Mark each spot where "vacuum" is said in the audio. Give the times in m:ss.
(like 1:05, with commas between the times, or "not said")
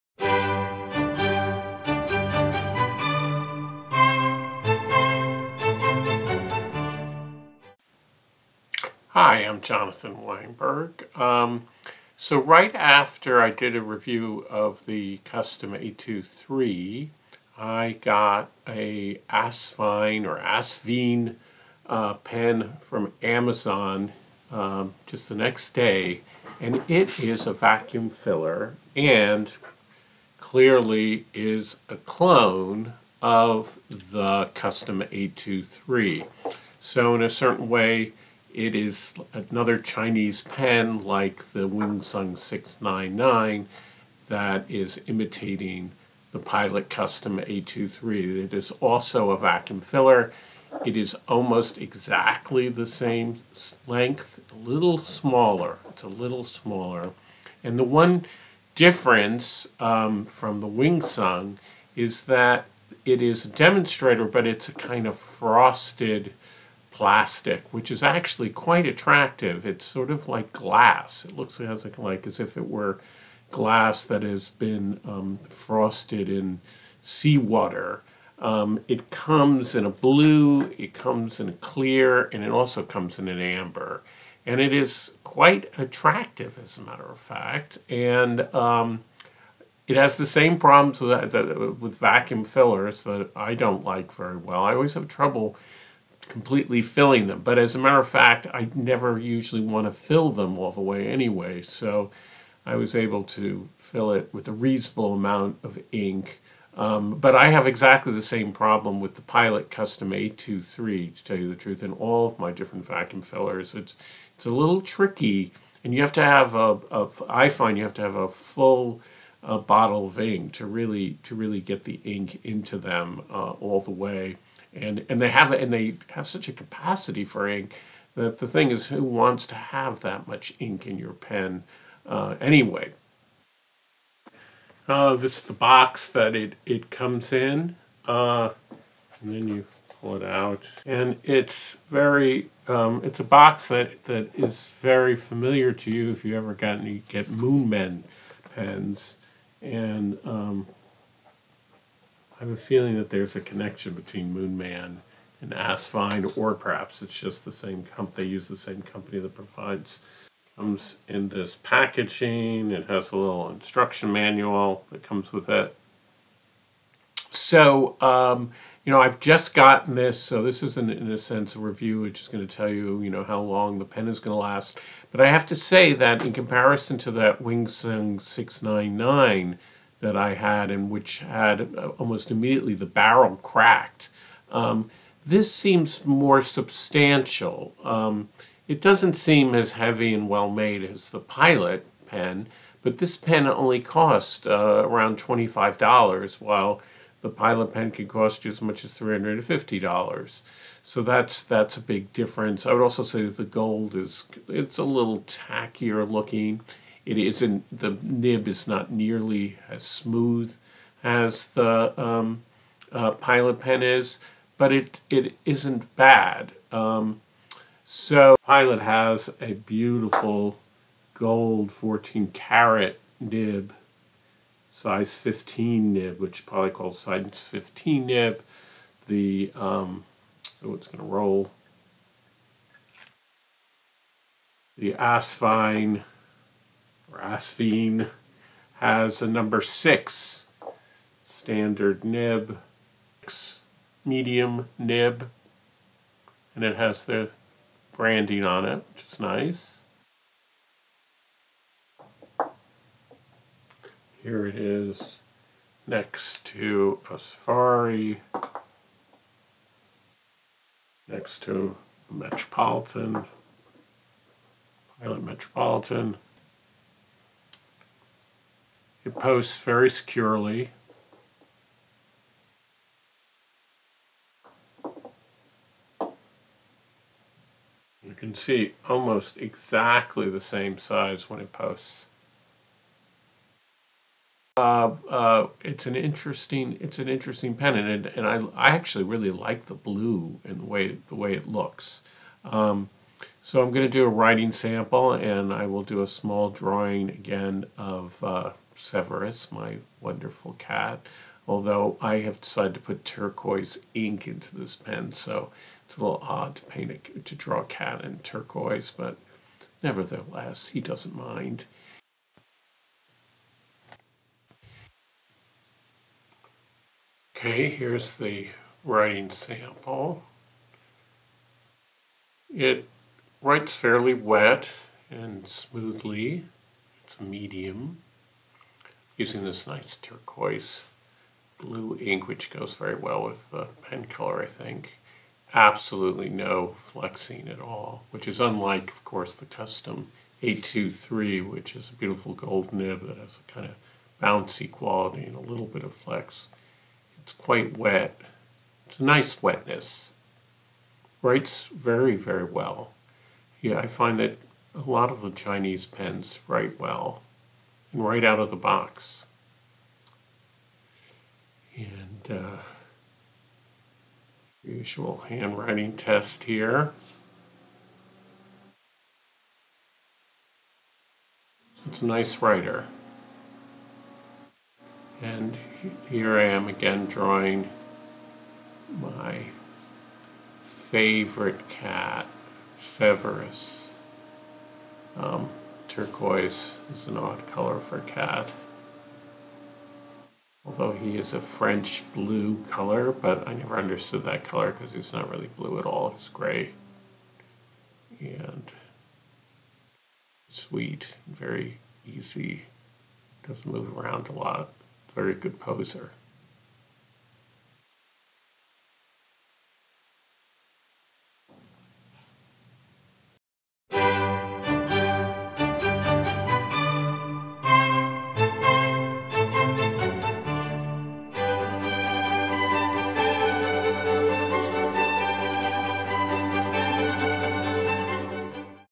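0:27, 0:49, 1:31, 1:52.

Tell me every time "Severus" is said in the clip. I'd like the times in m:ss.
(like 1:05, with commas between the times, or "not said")
4:58, 6:22.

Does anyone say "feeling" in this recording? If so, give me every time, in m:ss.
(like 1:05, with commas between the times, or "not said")
2:32.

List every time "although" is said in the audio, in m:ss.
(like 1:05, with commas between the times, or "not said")
5:01, 6:30.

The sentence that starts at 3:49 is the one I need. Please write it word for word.
The, um, so it's going to roll.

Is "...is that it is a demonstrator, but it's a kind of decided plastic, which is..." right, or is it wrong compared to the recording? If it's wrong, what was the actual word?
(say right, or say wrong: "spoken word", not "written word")
wrong: "frosted", not "decided".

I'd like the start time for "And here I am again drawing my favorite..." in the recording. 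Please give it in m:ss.
6:15.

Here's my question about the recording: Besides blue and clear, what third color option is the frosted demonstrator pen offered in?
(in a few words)
Amber.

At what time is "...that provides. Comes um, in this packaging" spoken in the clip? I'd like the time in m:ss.
2:39.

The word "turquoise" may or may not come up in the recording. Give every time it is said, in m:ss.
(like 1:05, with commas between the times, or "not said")
5:03, 5:08, 5:29, 6:25.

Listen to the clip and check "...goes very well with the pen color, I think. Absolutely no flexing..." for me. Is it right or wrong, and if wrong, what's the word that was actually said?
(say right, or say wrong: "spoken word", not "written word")
right.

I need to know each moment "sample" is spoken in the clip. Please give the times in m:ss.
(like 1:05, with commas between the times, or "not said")
4:54, 5:19.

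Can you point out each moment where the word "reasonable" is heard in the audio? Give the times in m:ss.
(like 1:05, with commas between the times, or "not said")
1:44.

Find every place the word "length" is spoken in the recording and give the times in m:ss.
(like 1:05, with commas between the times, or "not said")
0:53.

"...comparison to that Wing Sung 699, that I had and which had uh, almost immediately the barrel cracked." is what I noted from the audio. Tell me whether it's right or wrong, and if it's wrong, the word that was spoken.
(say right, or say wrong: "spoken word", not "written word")
right.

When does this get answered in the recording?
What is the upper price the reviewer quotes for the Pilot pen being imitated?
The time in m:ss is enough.
3:18.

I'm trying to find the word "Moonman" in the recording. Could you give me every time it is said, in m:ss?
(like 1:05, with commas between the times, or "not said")
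2:27, 2:34.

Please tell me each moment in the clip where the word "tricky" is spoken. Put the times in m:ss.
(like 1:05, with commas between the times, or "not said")
1:54.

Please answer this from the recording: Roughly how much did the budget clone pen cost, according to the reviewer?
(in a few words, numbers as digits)
$25.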